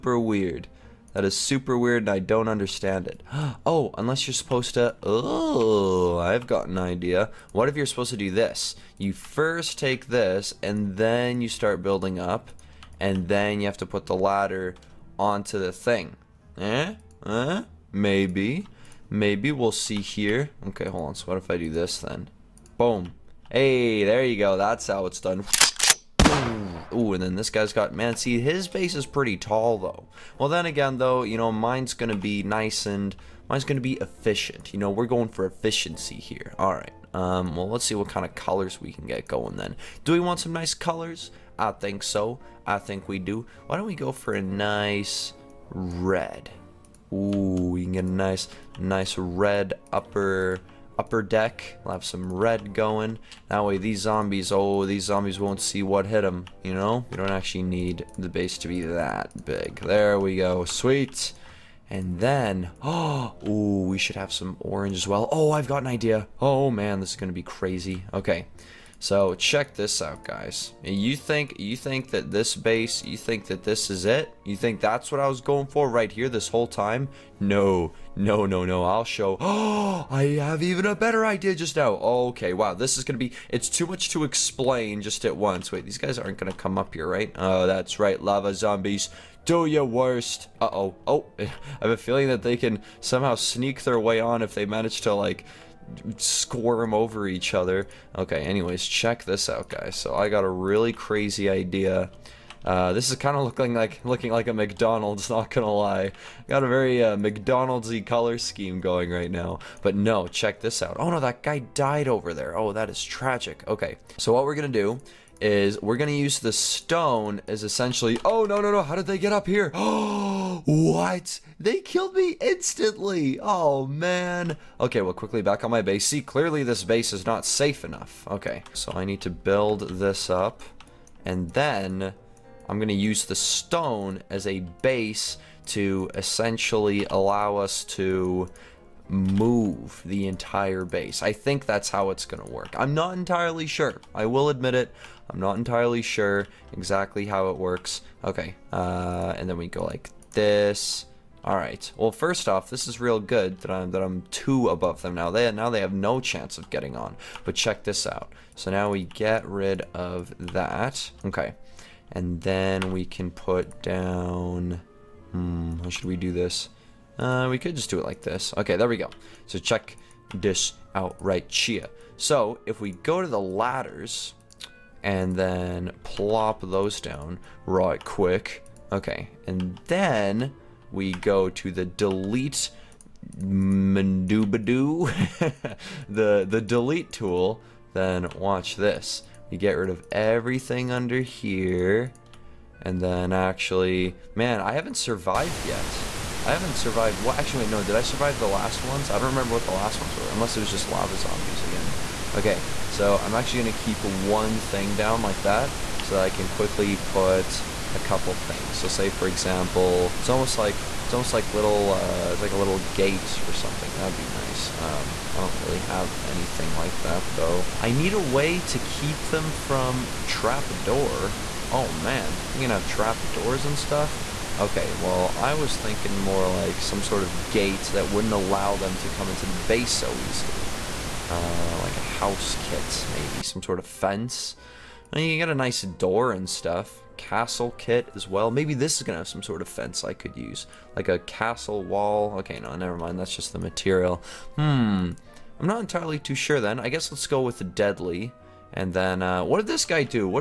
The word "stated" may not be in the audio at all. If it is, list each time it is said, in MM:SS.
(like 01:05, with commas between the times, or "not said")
not said.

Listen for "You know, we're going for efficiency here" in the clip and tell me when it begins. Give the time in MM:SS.
00:34.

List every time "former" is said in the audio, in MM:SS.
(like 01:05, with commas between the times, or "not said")
not said.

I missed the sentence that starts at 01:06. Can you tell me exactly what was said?
Oh man, this is gonna be crazy.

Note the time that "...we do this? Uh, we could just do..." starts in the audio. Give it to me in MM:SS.
02:46.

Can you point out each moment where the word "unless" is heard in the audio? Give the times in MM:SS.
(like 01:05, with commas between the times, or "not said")
00:03, 03:20.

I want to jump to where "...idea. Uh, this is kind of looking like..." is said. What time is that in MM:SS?
01:41.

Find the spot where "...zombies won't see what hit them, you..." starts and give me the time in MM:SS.
00:55.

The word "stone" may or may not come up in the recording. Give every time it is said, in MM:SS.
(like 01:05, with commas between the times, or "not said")
01:56, 02:13.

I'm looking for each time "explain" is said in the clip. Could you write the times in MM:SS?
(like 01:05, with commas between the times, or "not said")
01:24.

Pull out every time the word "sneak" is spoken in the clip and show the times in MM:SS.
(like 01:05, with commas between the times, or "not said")
01:33.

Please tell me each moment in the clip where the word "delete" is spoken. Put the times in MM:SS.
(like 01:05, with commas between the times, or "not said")
03:01, 03:06.